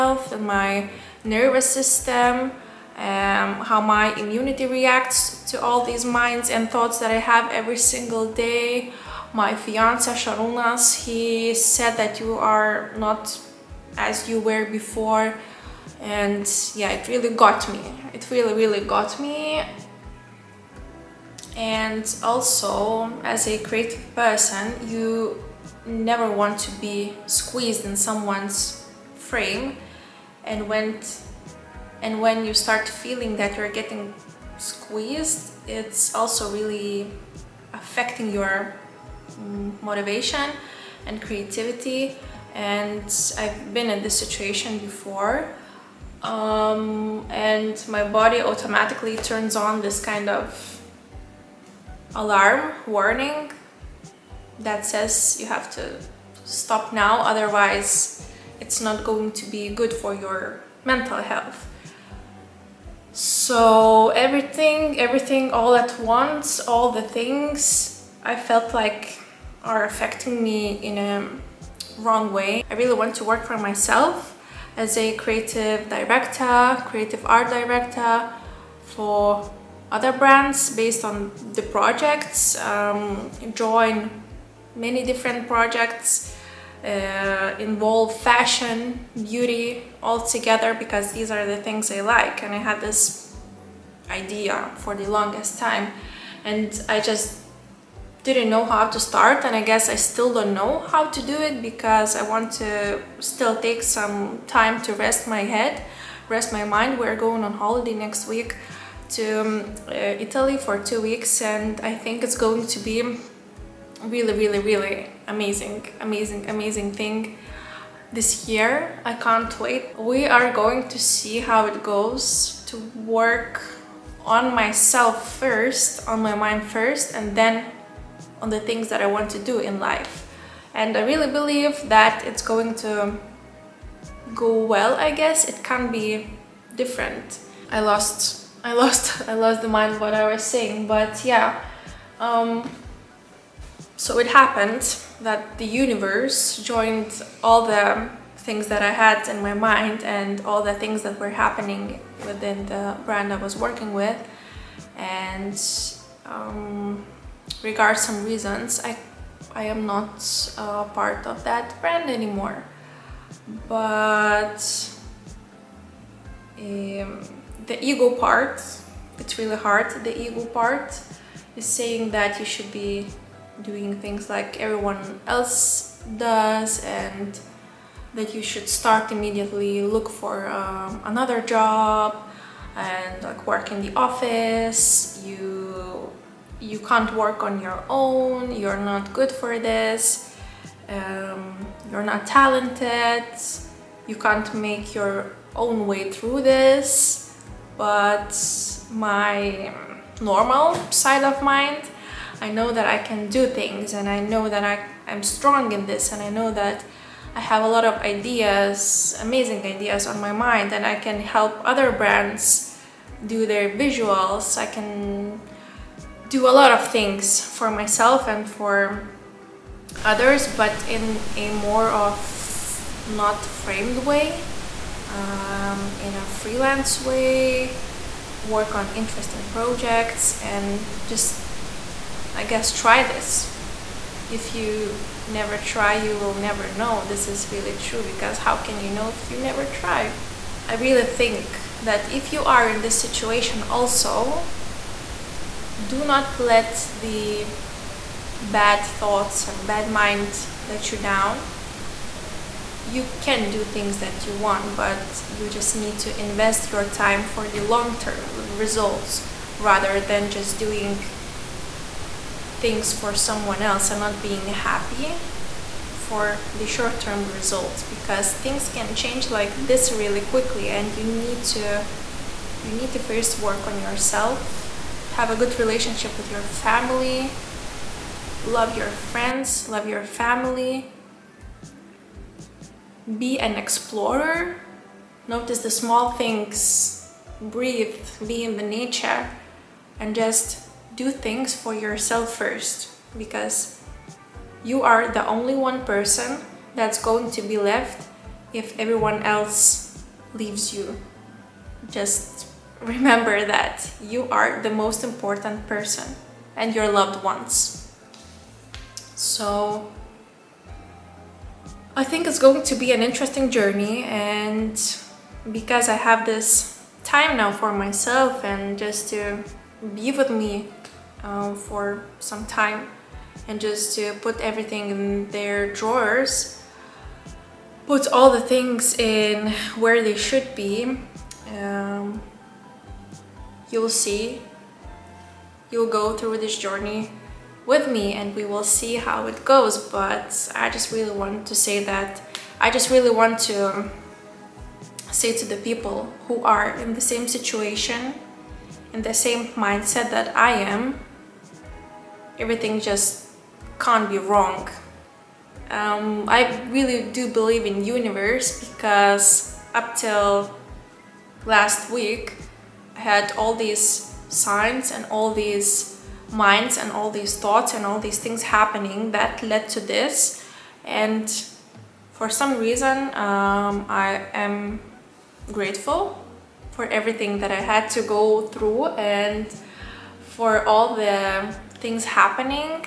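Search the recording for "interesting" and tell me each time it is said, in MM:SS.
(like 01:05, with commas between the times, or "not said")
03:48, 05:13.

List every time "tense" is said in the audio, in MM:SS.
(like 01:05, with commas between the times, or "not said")
not said.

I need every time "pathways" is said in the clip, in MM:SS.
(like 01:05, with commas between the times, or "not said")
not said.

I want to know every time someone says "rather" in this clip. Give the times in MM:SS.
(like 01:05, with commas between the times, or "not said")
04:19.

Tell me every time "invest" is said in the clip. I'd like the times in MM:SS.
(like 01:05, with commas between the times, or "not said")
04:16.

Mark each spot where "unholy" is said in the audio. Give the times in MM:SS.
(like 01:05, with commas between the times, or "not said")
not said.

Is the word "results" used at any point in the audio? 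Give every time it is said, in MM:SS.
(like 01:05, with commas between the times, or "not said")
04:18, 04:27.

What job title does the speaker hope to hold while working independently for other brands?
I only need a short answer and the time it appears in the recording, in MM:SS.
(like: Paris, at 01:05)
creative art director, at 01:16.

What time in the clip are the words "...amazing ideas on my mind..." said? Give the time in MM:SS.
03:29.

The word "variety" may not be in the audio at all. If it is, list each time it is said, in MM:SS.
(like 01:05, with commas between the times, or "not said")
not said.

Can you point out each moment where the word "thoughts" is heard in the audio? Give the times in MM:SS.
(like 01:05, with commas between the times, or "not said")
00:06, 04:08, 06:07.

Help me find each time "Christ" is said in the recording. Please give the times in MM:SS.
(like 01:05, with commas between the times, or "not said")
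not said.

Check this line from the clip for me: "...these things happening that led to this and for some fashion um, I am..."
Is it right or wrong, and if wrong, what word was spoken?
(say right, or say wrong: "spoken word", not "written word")
wrong: "reason", not "fashion".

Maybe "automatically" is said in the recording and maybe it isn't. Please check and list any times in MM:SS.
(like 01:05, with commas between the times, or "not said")
00:48.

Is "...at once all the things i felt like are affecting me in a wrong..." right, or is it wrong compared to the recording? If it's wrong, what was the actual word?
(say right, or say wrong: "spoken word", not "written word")
right.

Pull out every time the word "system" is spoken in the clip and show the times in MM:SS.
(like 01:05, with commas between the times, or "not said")
00:01.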